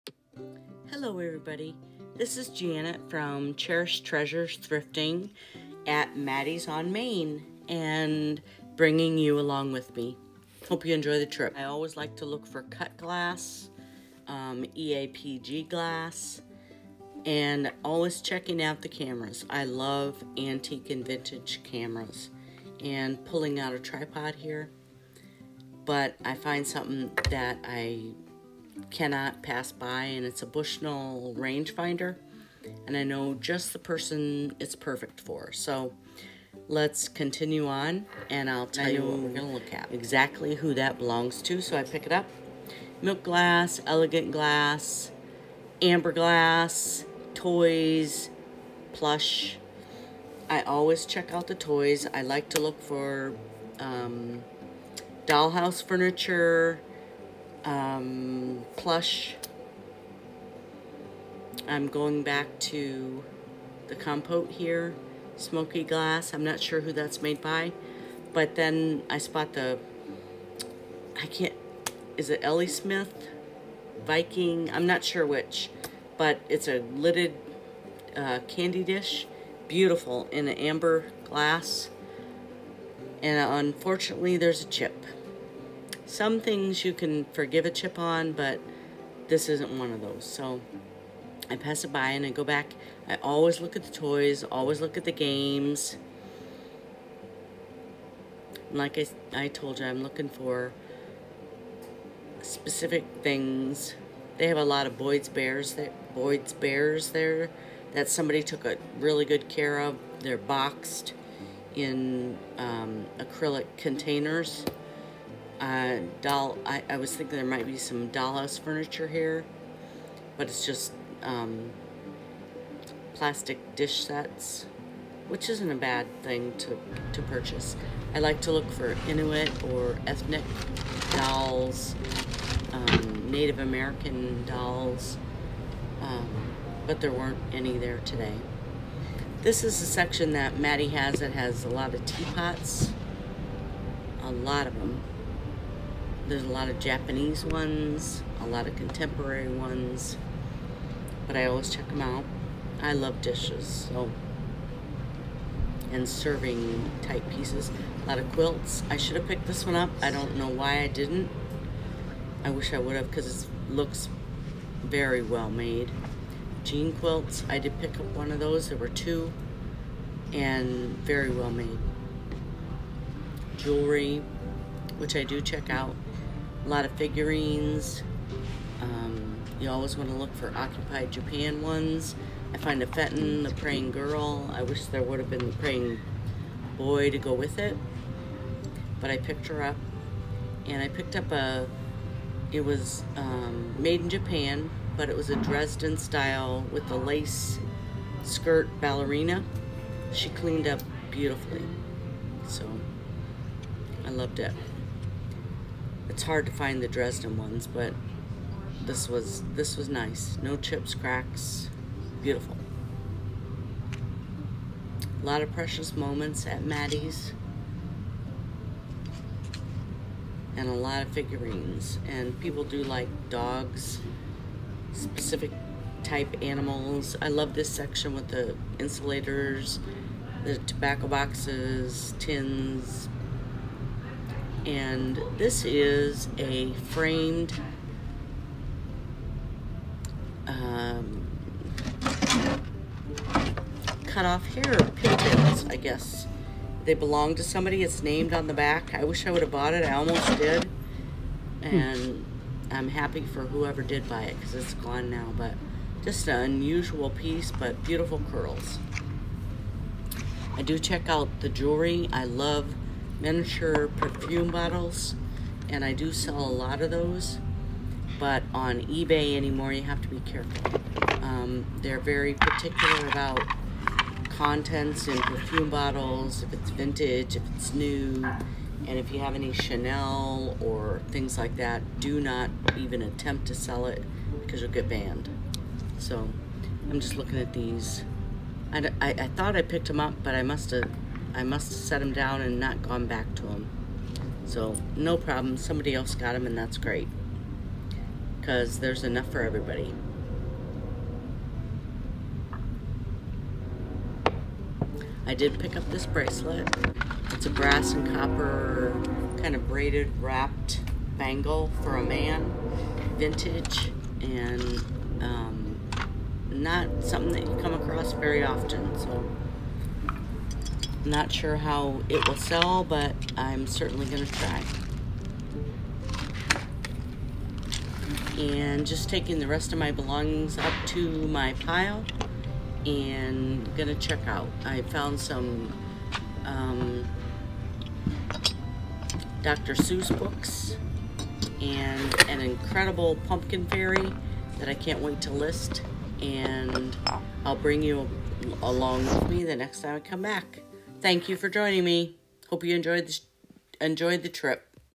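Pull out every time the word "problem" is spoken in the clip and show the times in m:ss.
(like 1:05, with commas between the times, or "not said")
4:55.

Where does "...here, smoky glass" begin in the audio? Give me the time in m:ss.
1:04.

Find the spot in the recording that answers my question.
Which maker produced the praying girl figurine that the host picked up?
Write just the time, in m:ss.
3:02.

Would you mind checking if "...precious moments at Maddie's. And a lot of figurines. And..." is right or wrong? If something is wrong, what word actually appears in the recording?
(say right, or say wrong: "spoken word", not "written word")
right.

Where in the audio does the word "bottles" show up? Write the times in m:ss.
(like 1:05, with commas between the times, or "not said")
4:24, 4:35.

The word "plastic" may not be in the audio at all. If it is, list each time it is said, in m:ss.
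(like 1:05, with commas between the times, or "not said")
2:03.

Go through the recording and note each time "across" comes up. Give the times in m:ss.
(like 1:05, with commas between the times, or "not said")
5:17.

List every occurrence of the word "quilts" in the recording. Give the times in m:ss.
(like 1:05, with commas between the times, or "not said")
2:38, 2:46.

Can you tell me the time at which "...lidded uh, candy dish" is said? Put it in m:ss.
1:16.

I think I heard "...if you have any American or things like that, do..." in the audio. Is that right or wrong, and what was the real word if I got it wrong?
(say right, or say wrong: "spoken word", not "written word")
wrong: "Chanel", not "American".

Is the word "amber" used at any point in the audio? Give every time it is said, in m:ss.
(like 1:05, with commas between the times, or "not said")
0:45, 1:20.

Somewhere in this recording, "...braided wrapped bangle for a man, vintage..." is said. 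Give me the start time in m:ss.
5:09.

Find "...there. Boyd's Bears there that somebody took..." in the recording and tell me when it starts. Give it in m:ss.
1:45.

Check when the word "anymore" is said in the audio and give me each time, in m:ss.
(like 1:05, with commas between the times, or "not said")
4:29.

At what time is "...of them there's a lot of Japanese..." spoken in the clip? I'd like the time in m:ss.
2:24.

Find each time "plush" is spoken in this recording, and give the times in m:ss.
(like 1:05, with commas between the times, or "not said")
0:48, 0:58.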